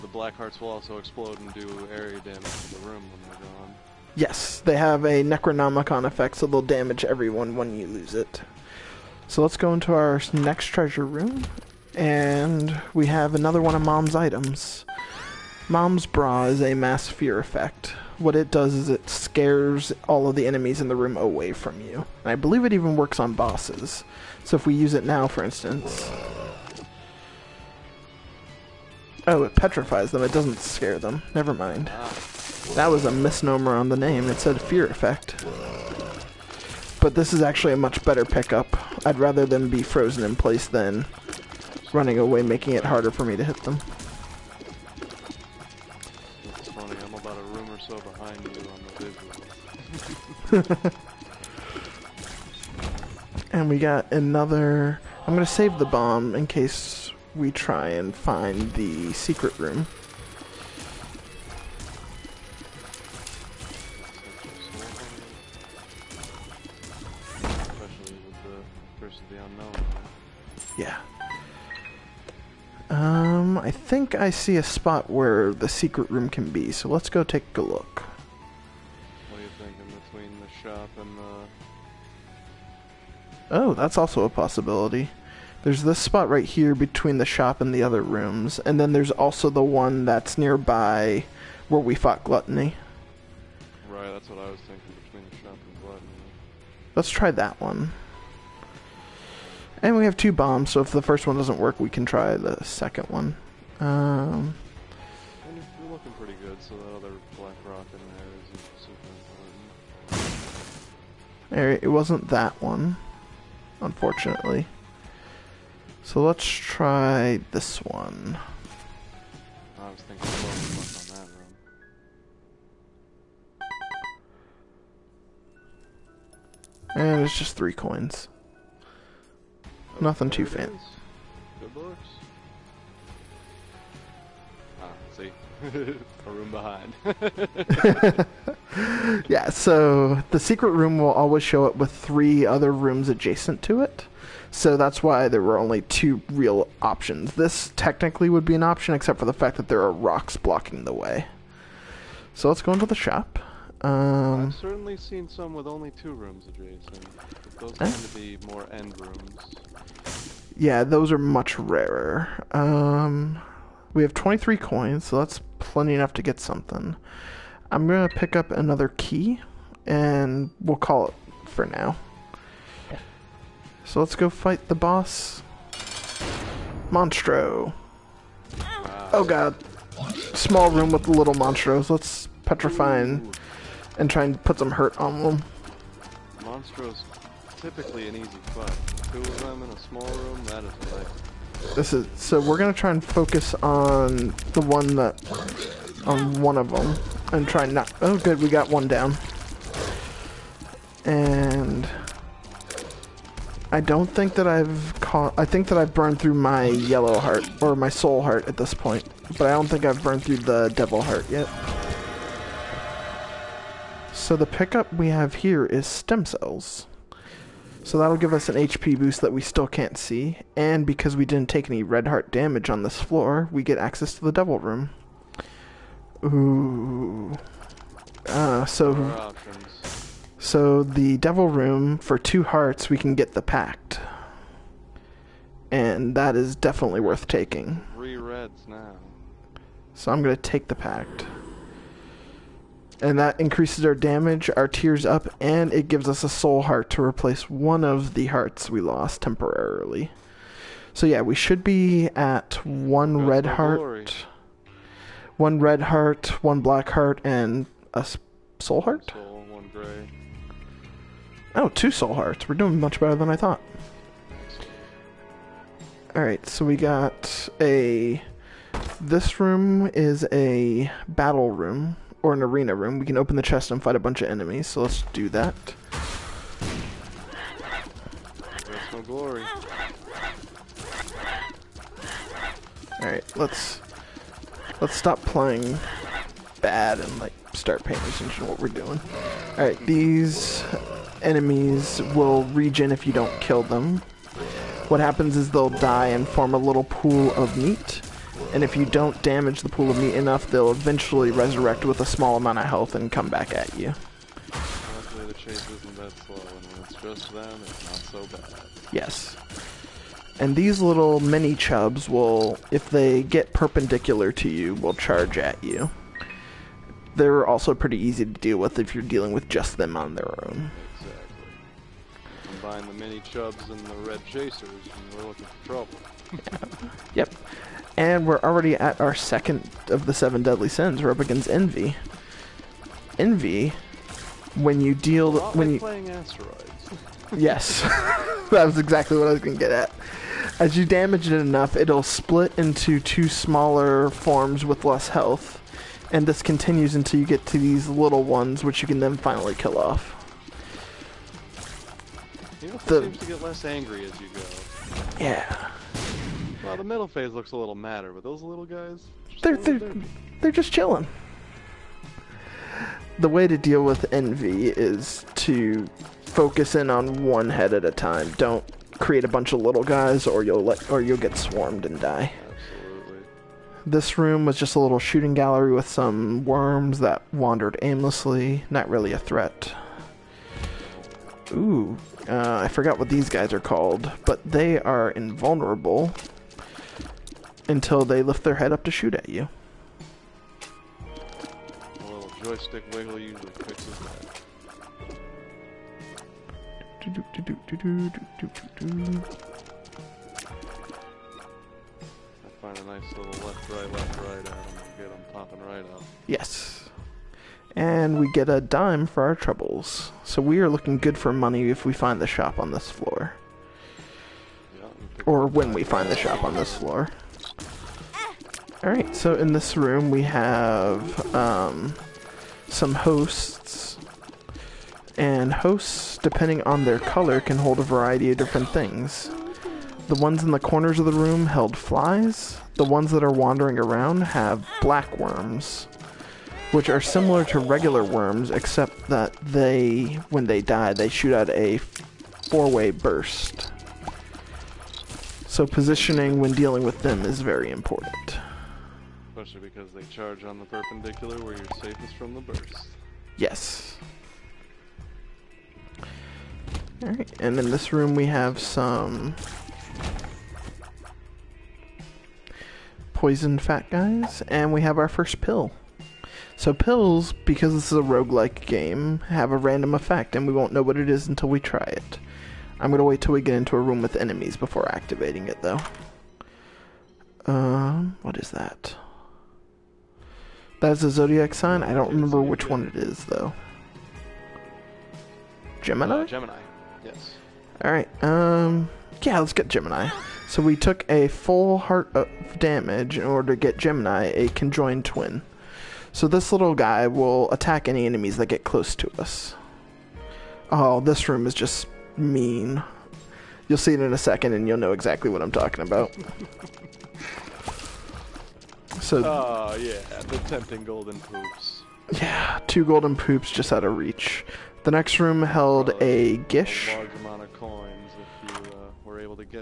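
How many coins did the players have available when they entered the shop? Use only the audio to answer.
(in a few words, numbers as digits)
23.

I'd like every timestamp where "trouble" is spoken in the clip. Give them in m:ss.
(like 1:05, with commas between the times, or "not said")
5:25, 6:49.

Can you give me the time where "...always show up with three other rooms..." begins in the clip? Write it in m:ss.
2:21.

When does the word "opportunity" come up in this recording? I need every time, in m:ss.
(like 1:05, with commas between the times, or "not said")
not said.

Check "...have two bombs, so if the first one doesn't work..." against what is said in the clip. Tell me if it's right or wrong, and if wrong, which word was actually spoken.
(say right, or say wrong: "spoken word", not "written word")
right.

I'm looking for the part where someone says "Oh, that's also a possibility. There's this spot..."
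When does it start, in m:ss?
1:23.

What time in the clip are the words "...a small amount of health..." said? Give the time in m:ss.
5:01.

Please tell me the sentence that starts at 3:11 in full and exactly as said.
This is so we're gonna try and focus on the one that on one of them and try not.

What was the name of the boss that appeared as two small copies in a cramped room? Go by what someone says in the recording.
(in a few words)
Monstro.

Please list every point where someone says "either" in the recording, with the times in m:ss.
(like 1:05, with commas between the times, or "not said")
not said.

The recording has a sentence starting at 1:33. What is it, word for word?
Right, that's what I was thinking, between the shop and Gluttony.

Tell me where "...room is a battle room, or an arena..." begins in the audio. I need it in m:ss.
4:29.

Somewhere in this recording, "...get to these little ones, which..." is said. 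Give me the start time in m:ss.
5:47.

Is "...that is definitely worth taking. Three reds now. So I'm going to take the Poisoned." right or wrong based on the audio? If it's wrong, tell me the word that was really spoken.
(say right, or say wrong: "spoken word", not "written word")
wrong: "Pact", not "Poisoned".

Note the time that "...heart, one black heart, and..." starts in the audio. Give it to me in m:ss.
4:15.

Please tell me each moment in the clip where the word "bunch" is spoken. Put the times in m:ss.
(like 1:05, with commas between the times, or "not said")
4:33, 6:09.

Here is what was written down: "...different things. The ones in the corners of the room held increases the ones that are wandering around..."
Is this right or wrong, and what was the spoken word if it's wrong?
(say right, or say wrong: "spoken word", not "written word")
wrong: "flies", not "increases".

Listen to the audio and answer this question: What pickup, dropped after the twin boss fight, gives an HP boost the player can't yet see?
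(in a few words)
Stem cells.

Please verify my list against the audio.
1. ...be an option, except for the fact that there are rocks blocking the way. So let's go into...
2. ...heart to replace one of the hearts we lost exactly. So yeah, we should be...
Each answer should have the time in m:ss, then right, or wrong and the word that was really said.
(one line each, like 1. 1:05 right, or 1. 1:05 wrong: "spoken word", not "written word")
1. 2:28 right
2. 4:06 wrong: "temporarily", not "exactly".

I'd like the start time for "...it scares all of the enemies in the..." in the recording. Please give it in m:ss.
0:18.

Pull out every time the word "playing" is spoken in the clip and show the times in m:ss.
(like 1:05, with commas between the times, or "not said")
4:45, 5:35.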